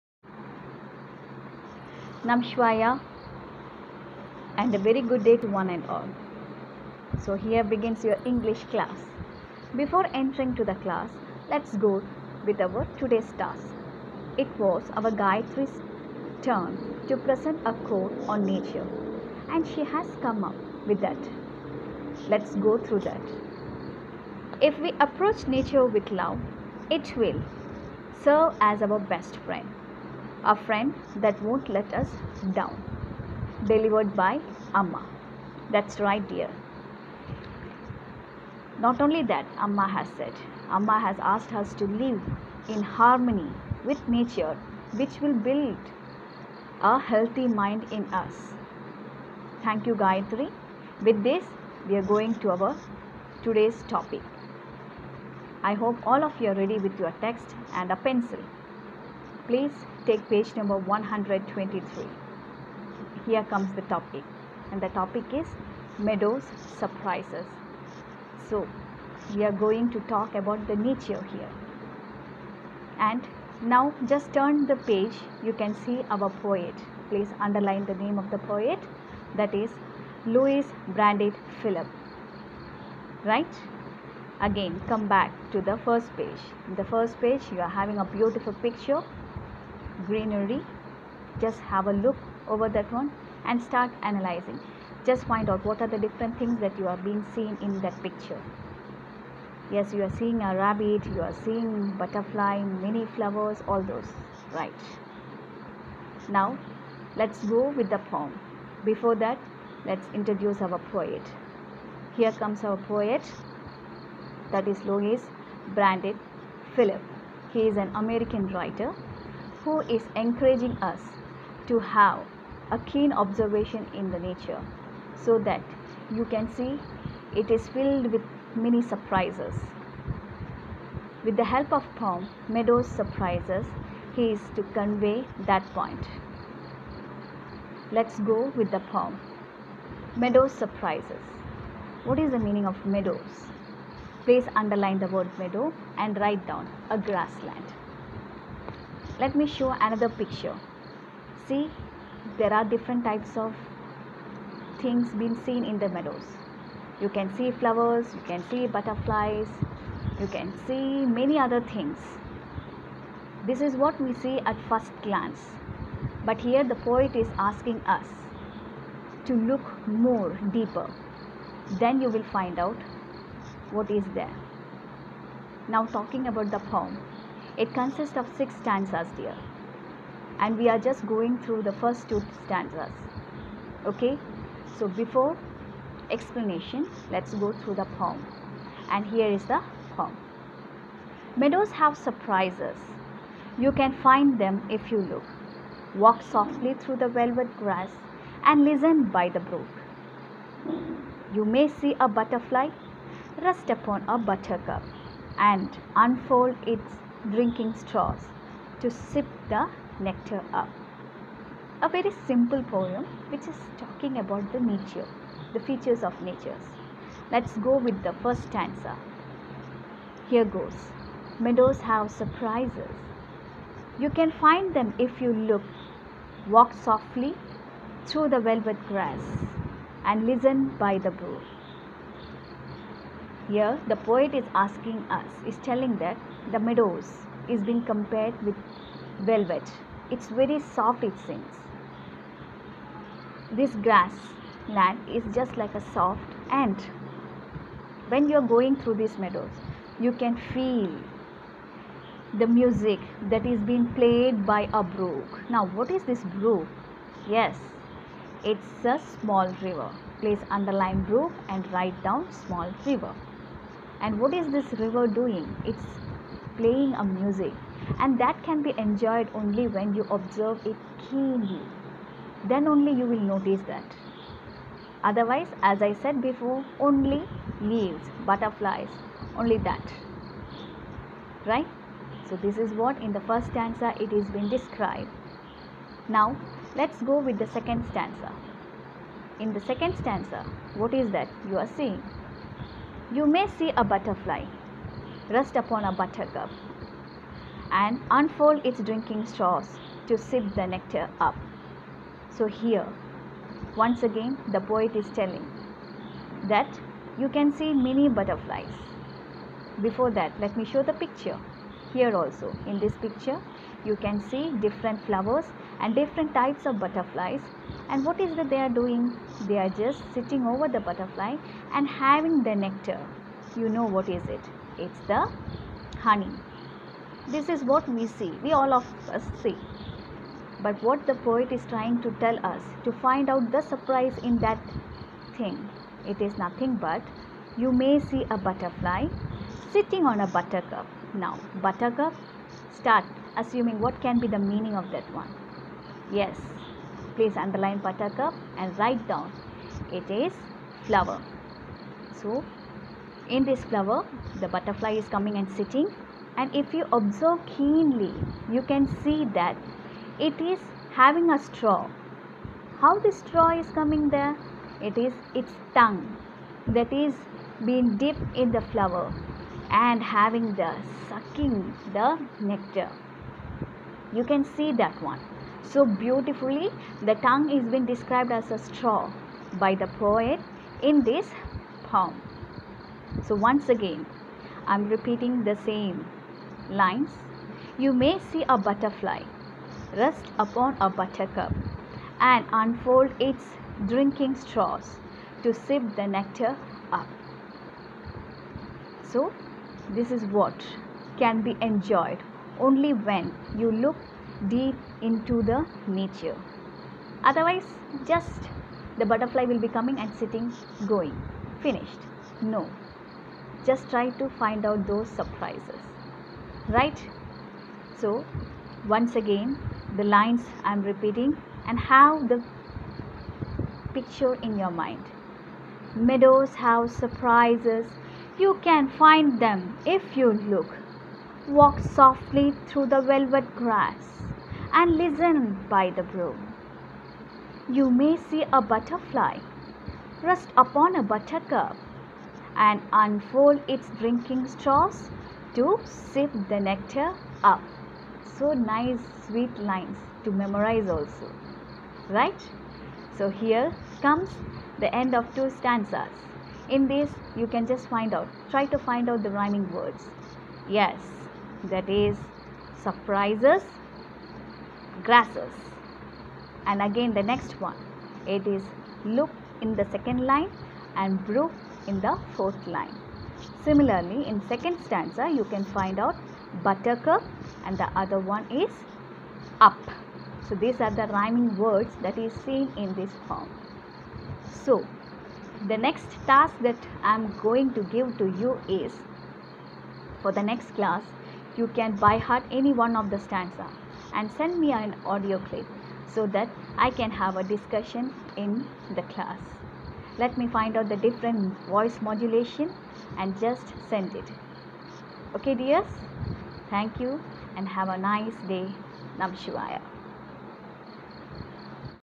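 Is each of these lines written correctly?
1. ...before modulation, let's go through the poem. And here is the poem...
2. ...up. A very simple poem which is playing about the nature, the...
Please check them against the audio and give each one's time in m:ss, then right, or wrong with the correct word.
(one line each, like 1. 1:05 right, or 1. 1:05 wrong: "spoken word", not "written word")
1. 3:04 wrong: "explanation", not "modulation"
2. 3:30 wrong: "talking", not "playing".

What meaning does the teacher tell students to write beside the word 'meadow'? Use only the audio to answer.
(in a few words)
A grassland.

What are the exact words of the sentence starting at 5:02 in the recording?
So, here, once again, the poet is telling that you can see many butterflies.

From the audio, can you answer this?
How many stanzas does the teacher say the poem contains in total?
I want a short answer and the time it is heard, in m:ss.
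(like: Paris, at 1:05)
6, at 2:58.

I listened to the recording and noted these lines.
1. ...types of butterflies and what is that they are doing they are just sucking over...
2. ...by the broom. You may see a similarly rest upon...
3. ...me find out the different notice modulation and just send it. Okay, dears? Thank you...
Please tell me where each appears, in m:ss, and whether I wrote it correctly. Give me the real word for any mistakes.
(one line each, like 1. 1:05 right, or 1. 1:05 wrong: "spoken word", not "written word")
1. 5:16 wrong: "sitting", not "sucking"
2. 7:15 wrong: "butterfly", not "similarly"
3. 8:20 wrong: "voice", not "notice".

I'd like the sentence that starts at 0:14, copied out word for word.
It was our Gayatri's turn to present a quote on nature and she has come up with that.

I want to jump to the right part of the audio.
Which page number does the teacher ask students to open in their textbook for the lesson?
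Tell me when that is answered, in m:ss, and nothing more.
1:00.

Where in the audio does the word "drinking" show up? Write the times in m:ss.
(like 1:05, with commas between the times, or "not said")
3:27, 4:58, 6:33, 7:23.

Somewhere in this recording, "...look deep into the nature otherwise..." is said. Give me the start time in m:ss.
6:43.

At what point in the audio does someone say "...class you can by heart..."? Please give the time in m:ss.
8:10.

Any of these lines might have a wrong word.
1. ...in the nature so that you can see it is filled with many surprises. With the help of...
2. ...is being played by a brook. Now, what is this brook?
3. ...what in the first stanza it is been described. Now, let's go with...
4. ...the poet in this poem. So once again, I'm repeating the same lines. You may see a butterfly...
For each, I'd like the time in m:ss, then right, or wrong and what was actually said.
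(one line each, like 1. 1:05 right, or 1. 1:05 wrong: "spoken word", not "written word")
1. 2:03 right
2. 4:13 right
3. 4:42 right
4. 6:19 right.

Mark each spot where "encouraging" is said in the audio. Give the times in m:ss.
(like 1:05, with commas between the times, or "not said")
2:00.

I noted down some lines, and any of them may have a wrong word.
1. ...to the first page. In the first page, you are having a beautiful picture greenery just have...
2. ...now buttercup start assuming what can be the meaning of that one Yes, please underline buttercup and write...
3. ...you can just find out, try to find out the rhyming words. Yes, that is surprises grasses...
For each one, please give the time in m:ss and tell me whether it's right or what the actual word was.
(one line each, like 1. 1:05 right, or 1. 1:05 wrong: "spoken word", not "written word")
1. 1:25 right
2. 5:41 right
3. 7:37 right.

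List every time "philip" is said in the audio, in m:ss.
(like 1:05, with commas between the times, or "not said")
1:21, 1:56.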